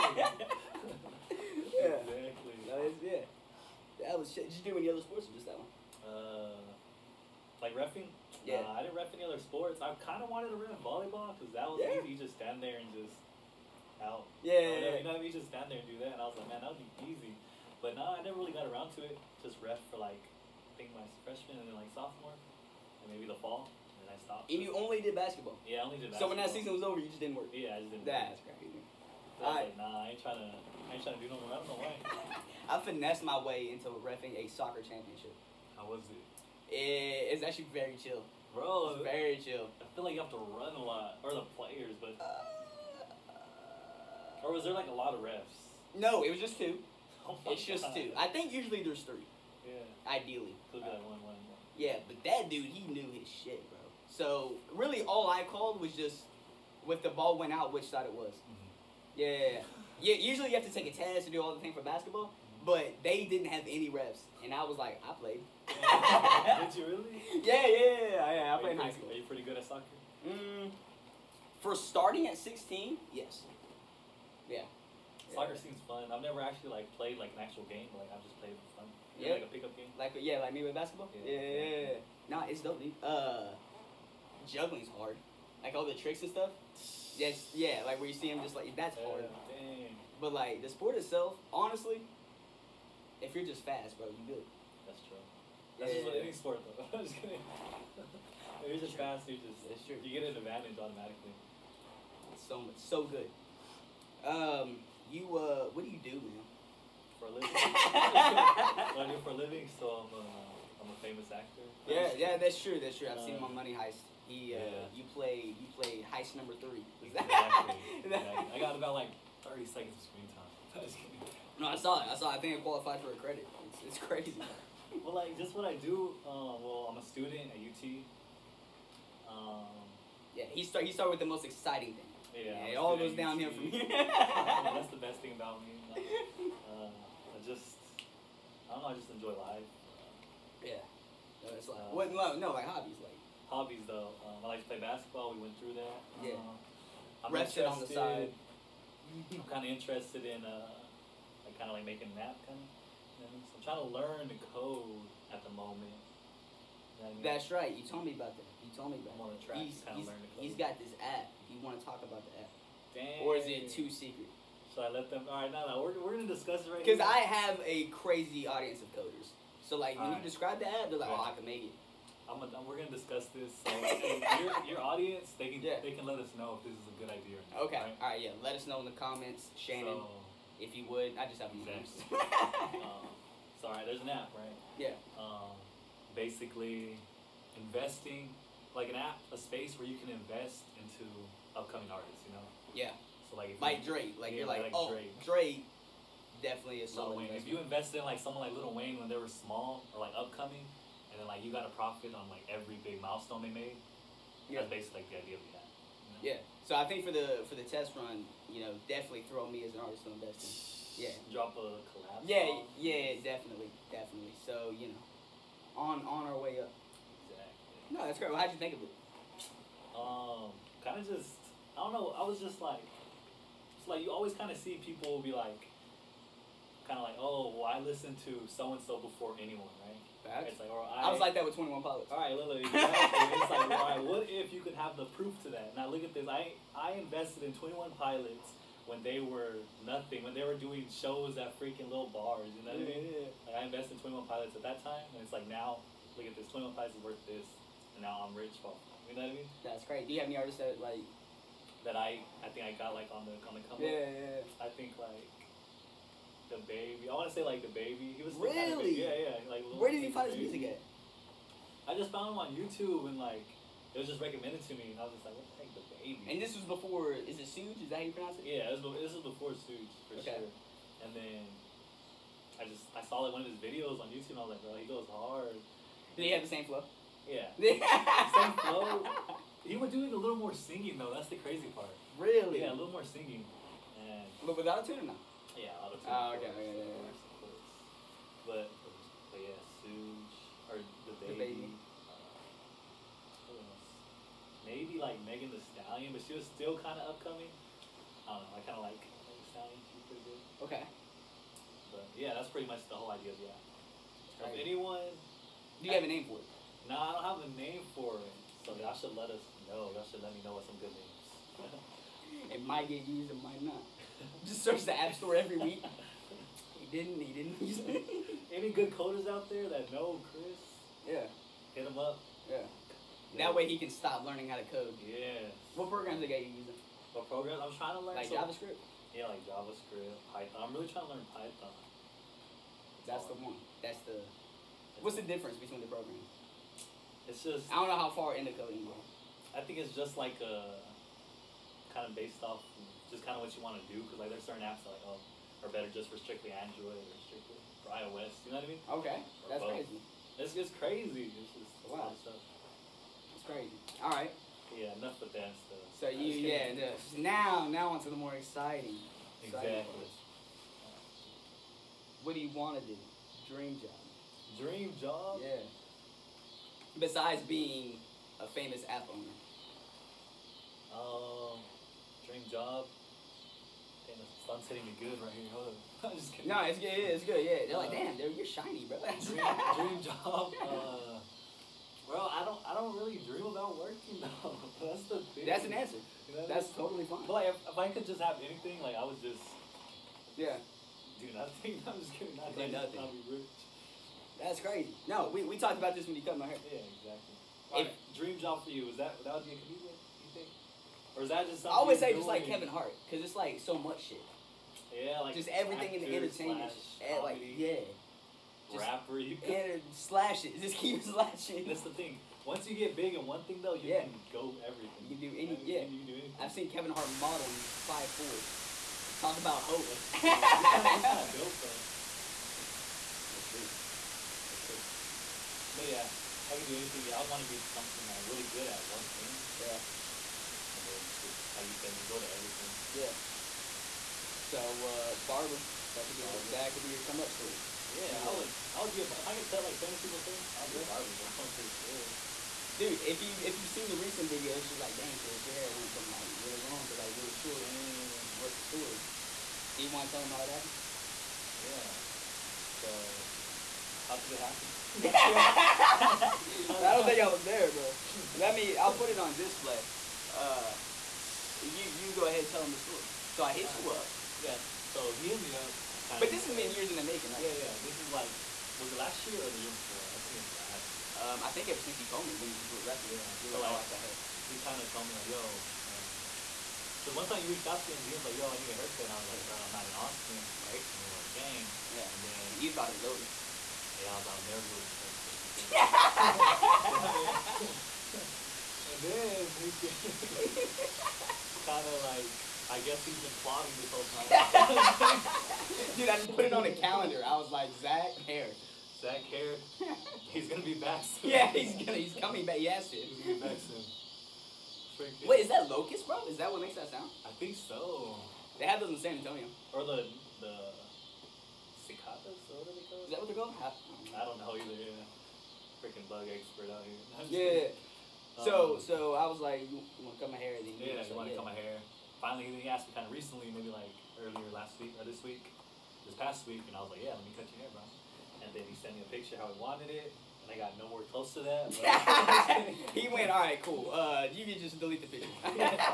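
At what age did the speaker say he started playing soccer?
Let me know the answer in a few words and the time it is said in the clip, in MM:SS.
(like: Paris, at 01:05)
16, at 01:11.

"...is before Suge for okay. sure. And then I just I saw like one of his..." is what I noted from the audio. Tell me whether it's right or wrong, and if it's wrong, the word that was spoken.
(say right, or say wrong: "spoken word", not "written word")
right.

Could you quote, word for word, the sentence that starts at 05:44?
Because like there's certain apps that like oh, are better just for strictly Android or strictly for iOS.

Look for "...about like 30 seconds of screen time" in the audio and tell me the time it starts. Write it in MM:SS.
01:58.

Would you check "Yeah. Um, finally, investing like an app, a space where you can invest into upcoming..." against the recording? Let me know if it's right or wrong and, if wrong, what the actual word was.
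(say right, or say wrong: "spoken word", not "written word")
wrong: "basically", not "finally".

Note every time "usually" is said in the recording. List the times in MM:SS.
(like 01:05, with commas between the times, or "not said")
00:48, 01:00.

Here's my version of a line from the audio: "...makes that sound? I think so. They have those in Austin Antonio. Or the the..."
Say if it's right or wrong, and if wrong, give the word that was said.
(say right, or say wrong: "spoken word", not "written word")
wrong: "San", not "Austin".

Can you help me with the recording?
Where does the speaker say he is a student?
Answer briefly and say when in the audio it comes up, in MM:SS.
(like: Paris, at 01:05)
UT, at 02:06.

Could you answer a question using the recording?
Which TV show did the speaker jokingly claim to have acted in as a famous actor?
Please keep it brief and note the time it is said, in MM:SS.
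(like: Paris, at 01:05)
Money Heist, at 01:53.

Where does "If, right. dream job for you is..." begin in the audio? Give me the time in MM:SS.
06:37.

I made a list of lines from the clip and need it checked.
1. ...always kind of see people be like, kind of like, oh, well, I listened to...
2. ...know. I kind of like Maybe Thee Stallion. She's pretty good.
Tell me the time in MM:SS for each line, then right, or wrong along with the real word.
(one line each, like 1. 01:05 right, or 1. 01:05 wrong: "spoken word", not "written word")
1. 03:44 right
2. 04:58 wrong: "Megan", not "Maybe".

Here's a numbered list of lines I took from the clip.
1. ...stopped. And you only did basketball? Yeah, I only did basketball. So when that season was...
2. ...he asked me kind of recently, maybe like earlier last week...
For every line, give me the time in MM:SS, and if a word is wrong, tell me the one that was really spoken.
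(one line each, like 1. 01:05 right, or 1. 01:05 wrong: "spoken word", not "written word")
1. 00:24 right
2. 08:42 right.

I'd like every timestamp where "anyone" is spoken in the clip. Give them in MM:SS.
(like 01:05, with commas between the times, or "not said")
03:49, 05:04.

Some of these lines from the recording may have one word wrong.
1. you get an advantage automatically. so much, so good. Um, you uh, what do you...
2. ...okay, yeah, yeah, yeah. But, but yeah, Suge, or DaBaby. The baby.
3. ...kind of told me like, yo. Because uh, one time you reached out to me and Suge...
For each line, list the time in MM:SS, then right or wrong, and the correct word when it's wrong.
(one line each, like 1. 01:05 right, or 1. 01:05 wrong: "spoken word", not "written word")
1. 01:40 right
2. 04:46 right
3. 07:54 wrong: "DMs", not "Suge".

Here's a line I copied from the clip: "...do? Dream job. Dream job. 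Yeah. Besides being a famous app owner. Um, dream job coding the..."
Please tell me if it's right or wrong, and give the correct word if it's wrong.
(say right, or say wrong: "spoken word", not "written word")
wrong: "hitting", not "coding".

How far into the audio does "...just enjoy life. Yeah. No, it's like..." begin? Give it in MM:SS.
02:18.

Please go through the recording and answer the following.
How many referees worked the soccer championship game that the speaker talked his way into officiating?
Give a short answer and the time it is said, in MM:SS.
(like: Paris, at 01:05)
2, at 00:46.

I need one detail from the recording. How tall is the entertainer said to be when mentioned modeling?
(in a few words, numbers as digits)
5'4".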